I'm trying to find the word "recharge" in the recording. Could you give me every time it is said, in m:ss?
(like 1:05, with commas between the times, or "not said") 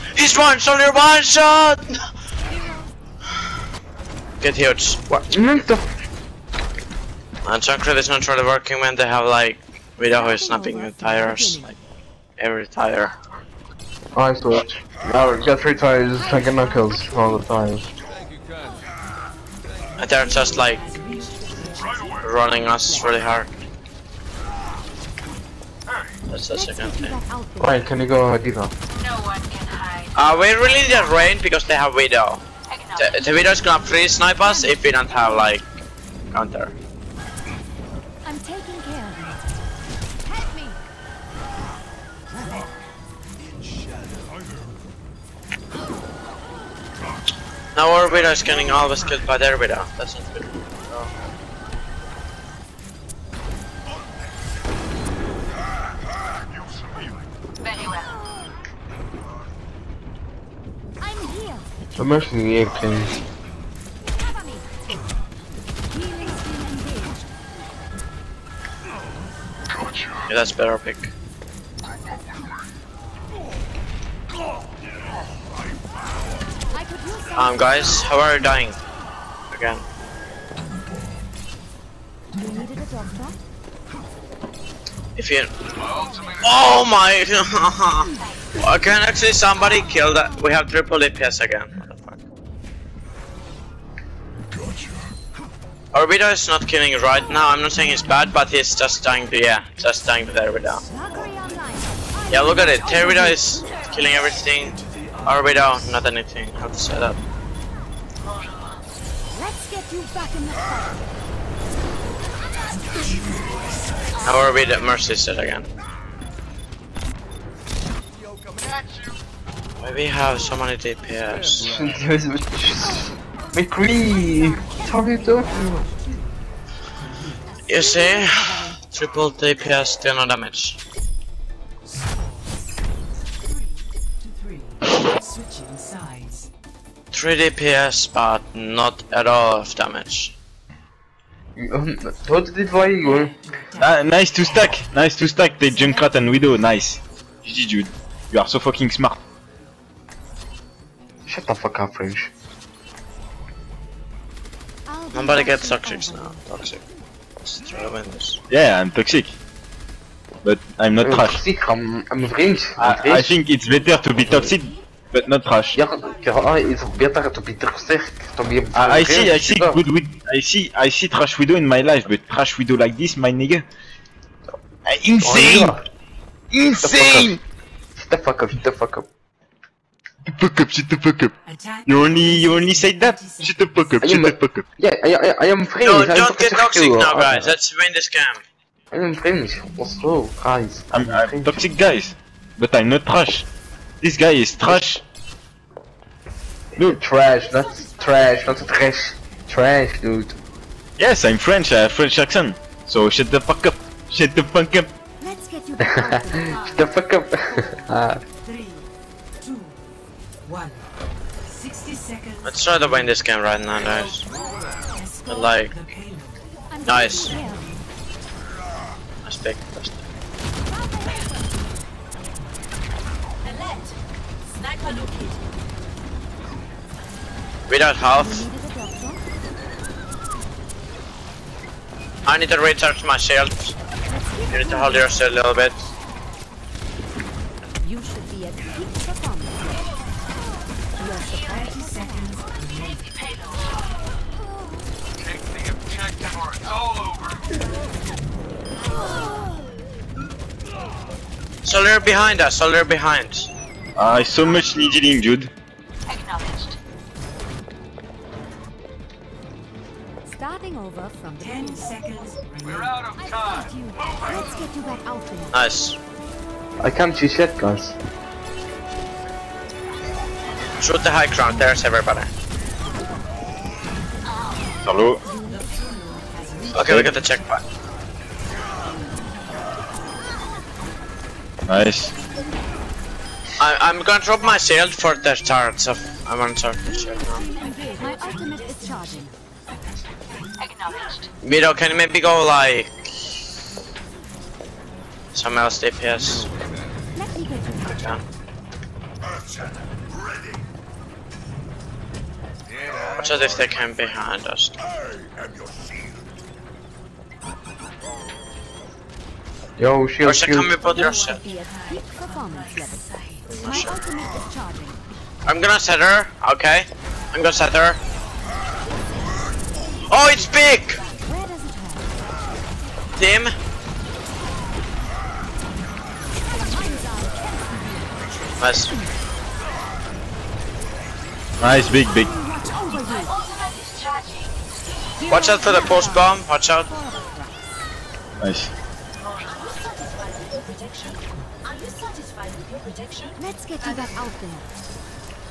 3:52.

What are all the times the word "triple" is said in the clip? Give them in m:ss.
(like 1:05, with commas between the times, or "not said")
1:30, 2:08.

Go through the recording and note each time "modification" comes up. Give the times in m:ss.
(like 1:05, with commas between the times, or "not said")
not said.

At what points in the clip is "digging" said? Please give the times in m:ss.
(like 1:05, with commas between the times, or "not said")
not said.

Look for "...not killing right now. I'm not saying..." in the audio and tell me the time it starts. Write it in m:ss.
1:36.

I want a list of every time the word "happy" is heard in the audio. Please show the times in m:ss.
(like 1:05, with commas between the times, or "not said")
not said.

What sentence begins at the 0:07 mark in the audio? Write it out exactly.
And Chakra is not really working when they have like without her snapping the tires, like every tire.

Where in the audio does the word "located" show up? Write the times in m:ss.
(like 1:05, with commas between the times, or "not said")
3:44.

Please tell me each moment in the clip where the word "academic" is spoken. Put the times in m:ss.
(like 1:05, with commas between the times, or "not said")
not said.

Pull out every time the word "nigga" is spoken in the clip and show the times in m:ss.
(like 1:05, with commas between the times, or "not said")
2:53.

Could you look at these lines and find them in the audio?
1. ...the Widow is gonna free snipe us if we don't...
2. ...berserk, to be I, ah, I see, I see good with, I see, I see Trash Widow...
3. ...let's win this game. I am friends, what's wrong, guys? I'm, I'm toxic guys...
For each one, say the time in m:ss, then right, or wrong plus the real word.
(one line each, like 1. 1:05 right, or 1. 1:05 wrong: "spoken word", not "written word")
1. 0:33 right
2. 2:47 right
3. 3:07 right.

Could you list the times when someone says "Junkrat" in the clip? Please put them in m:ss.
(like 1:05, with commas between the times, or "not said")
2:25.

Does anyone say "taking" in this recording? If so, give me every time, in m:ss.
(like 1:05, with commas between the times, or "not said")
0:16.